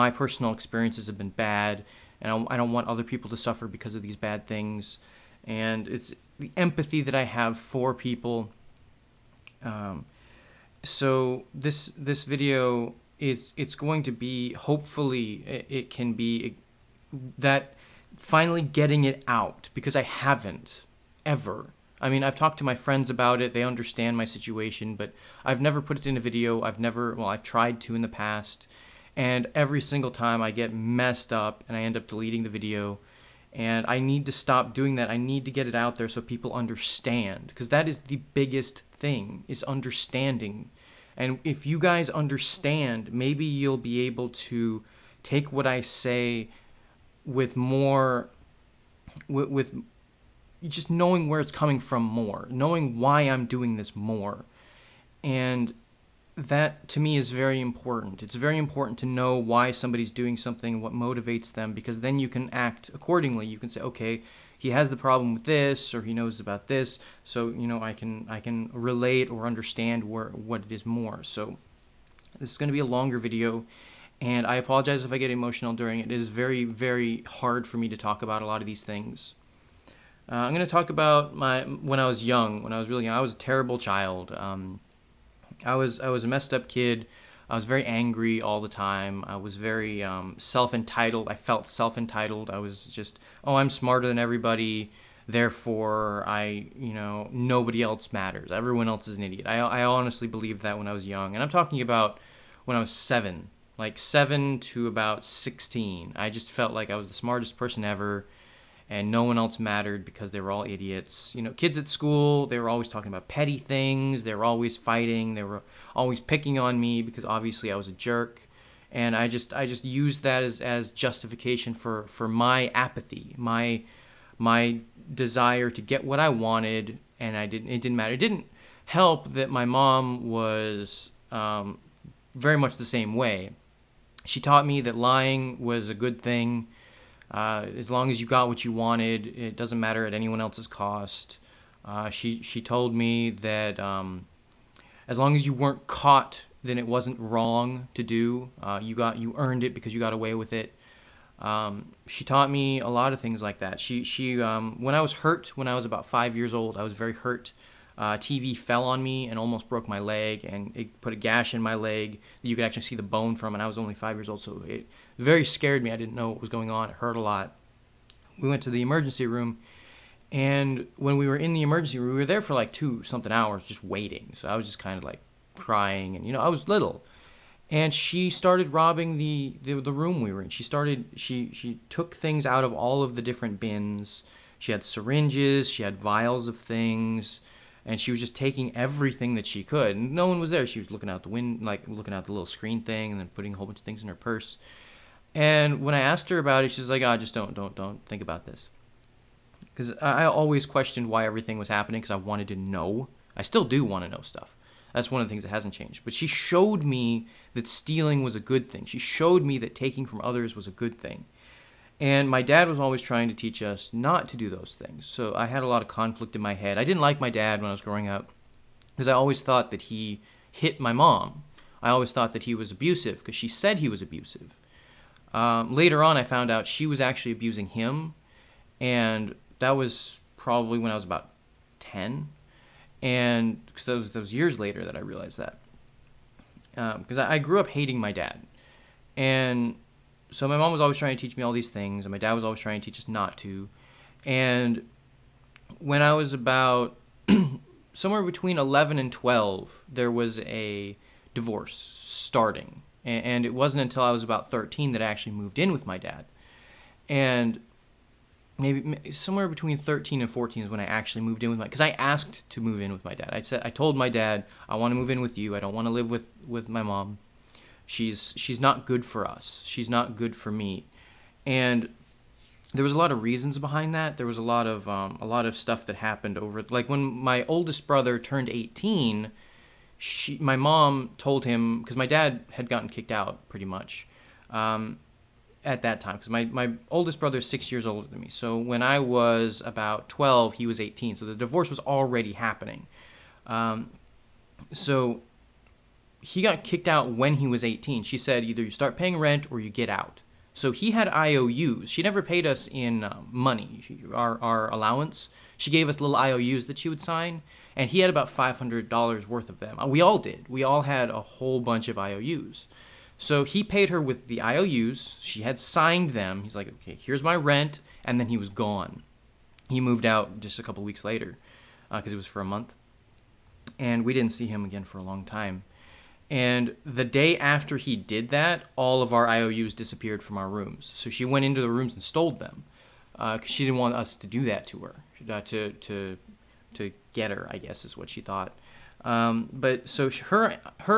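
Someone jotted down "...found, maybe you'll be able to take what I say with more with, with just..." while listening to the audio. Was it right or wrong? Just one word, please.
wrong.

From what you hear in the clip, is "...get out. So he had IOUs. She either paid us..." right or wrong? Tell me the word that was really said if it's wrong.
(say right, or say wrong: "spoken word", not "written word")
wrong: "never", not "either".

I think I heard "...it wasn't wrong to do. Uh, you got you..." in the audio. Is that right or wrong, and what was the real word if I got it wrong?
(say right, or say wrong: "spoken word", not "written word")
right.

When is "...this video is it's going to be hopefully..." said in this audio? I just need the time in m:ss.
0:11.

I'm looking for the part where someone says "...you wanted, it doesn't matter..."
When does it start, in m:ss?
2:18.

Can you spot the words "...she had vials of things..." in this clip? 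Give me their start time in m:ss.
3:05.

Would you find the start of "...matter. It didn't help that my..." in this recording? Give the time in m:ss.
2:07.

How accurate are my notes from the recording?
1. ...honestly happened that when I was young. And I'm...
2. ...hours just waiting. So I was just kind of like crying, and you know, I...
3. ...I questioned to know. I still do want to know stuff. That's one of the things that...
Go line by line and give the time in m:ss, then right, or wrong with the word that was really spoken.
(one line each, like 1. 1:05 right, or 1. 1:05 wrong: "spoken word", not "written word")
1. 1:39 wrong: "believed", not "happened"
2. 2:53 right
3. 3:22 wrong: "wanted", not "questioned".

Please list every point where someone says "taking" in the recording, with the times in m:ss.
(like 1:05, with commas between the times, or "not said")
3:08, 3:29.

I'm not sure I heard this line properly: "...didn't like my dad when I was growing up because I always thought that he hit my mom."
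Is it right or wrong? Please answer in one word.
right.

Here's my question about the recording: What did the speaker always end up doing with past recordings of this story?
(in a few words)
deleting the video.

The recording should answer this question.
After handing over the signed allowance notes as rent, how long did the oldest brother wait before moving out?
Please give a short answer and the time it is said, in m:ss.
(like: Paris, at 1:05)
a couple weeks, at 5:20.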